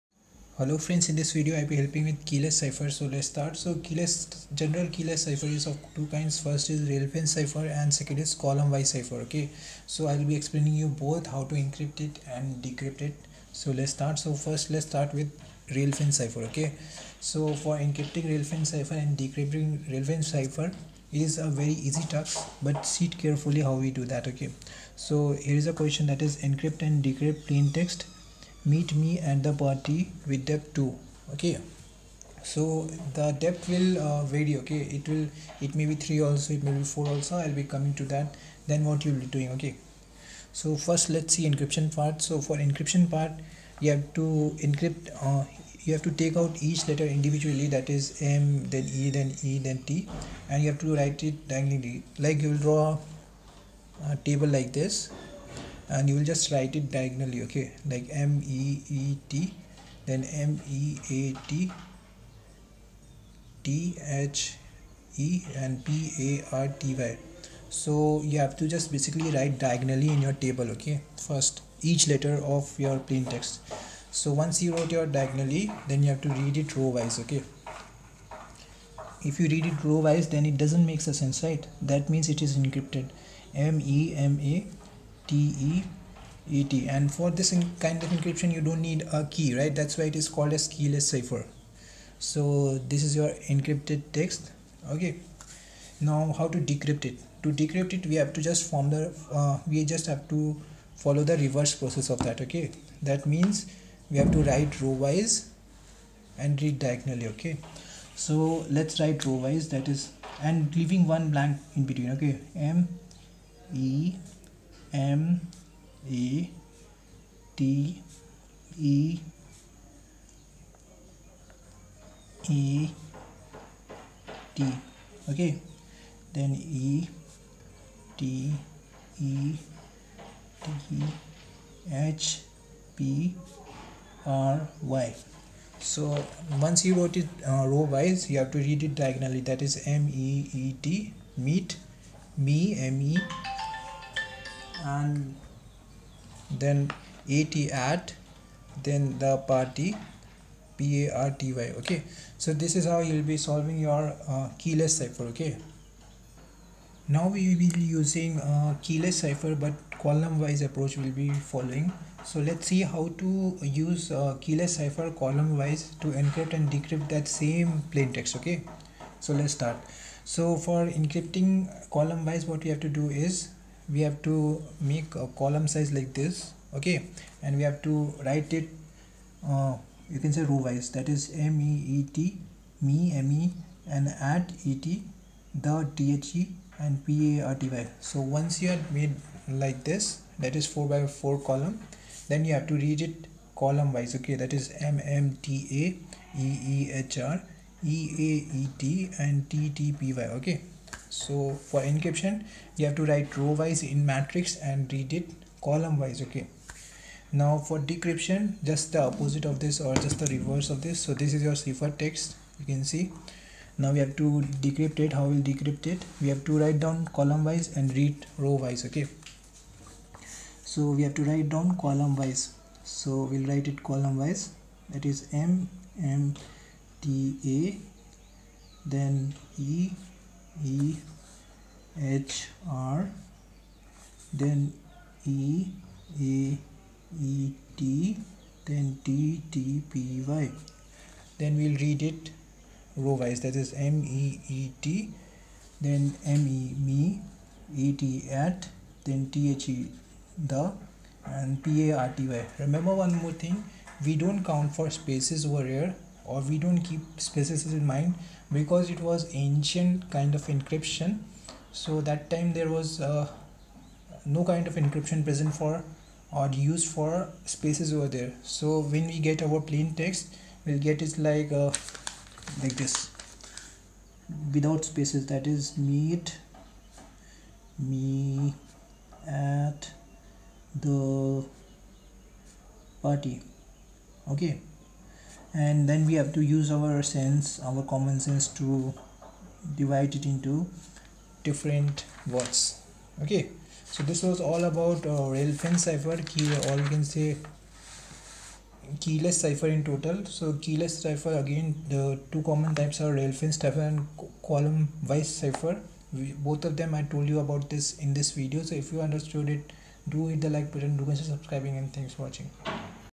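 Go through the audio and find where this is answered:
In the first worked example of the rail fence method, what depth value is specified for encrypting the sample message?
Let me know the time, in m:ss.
0:30.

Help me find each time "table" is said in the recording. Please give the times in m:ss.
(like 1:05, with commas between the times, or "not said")
0:54, 1:10.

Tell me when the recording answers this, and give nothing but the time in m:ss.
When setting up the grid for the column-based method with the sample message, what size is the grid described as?
3:10.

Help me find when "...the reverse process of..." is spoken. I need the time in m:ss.
1:41.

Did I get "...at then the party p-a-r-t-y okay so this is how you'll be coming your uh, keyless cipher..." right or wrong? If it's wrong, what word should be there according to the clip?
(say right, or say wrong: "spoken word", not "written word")
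wrong: "solving", not "coming".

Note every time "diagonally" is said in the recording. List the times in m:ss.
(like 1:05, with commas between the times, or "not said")
0:51, 0:56, 1:09, 1:15, 1:46, 2:18.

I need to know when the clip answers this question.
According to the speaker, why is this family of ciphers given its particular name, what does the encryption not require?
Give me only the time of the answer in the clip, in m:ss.
1:28.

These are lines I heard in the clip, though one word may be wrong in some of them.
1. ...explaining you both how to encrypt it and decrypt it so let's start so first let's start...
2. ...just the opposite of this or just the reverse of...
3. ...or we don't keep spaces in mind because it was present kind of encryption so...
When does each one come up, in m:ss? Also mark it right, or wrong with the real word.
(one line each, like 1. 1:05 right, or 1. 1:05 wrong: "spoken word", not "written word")
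1. 0:10 right
2. 3:28 right
3. 4:16 wrong: "ancient", not "present".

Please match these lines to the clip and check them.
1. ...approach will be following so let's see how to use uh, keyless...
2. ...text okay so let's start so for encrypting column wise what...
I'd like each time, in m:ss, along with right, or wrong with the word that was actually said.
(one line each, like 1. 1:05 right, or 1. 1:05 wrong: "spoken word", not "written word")
1. 2:40 right
2. 2:48 right.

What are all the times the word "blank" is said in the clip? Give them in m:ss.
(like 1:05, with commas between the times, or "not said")
1:51.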